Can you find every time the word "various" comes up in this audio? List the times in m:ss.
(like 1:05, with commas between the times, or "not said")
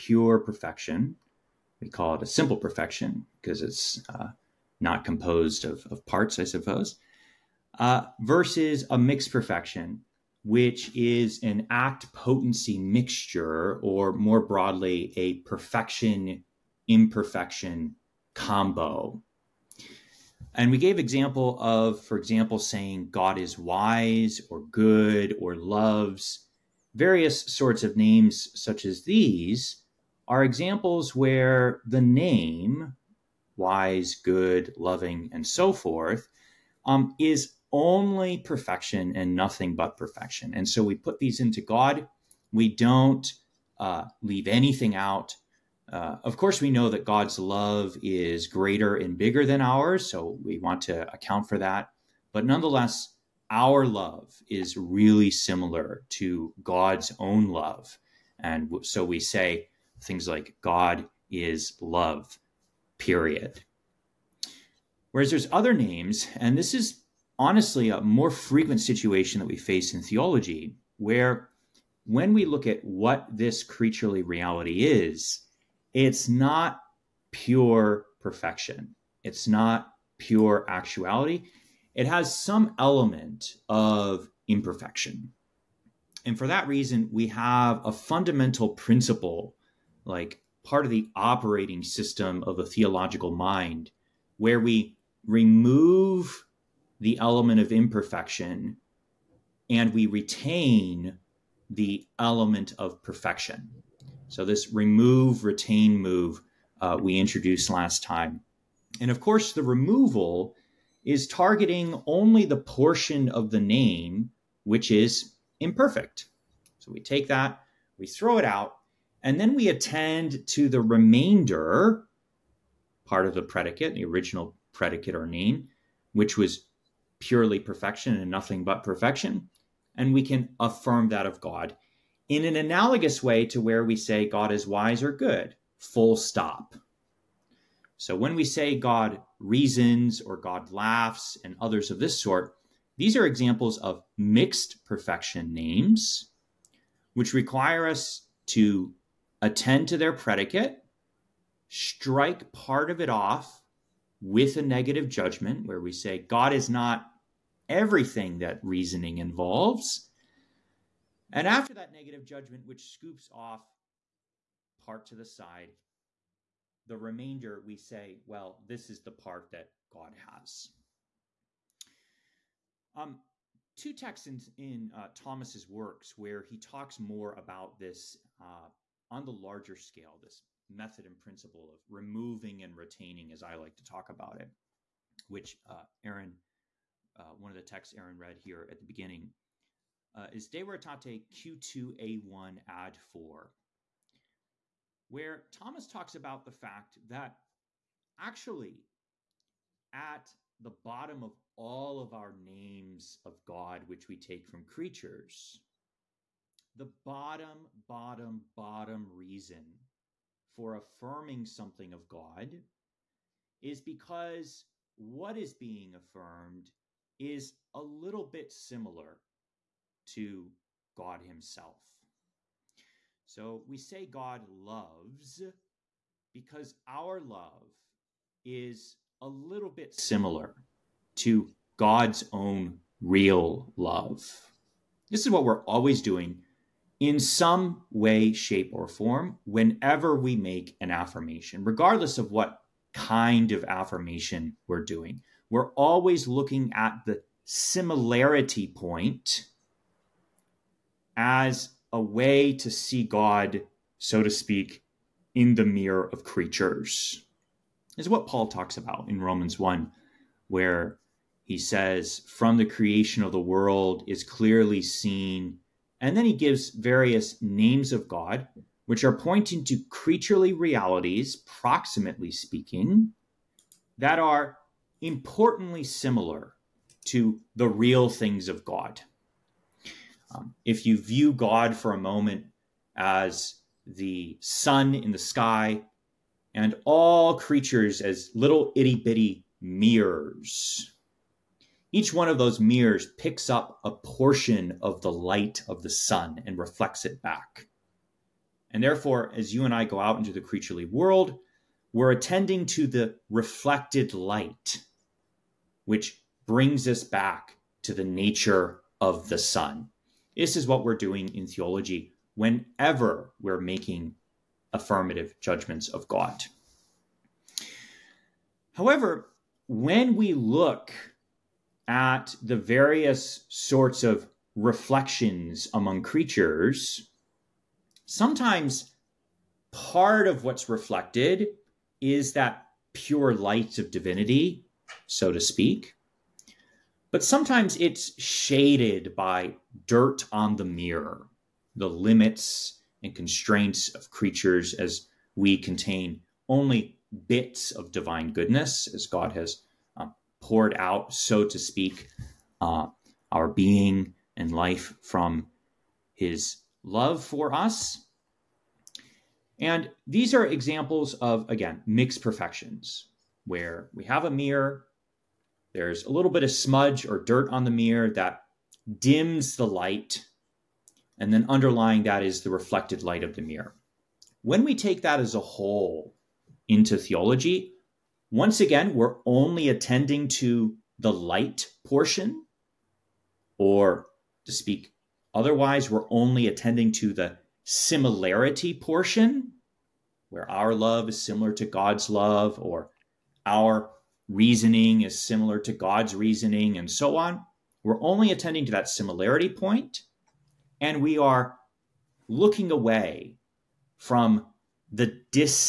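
0:26, 4:26, 5:22.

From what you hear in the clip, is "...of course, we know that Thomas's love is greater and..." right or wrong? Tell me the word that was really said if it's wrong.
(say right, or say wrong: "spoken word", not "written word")
wrong: "God", not "Thomas".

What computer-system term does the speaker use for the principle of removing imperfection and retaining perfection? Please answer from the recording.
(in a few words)
Operating system.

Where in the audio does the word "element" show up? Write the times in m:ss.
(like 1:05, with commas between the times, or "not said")
1:22, 1:37, 1:42.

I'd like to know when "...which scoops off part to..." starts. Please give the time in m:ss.
2:42.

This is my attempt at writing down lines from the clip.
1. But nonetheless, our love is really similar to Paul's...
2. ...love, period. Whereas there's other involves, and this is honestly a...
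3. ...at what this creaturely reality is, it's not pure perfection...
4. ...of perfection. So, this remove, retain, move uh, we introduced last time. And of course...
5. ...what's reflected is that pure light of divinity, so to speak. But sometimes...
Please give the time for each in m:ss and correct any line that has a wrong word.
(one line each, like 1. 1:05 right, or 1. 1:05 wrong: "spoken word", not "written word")
1. 0:52 wrong: "God", not "Paul"
2. 1:01 wrong: "names", not "involves"
3. 1:12 right
4. 1:42 right
5. 5:30 right.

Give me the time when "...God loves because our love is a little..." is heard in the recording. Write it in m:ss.
3:44.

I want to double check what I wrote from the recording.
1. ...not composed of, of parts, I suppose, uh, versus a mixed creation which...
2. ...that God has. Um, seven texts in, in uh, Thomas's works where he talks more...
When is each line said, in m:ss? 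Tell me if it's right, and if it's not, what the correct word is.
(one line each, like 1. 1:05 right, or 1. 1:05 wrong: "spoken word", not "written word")
1. 0:04 wrong: "perfection", not "creation"
2. 2:49 wrong: "two", not "seven".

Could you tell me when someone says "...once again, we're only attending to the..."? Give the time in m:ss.
6:18.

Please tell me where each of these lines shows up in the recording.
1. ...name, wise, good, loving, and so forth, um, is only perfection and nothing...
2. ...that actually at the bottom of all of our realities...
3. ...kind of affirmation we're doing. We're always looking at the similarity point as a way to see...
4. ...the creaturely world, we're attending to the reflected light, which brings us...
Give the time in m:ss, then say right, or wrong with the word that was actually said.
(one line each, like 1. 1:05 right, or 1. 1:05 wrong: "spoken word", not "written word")
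1. 0:32 right
2. 3:17 wrong: "names", not "realities"
3. 4:02 right
4. 5:00 right.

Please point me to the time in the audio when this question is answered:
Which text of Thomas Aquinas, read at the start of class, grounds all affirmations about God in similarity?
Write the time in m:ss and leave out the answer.
3:10.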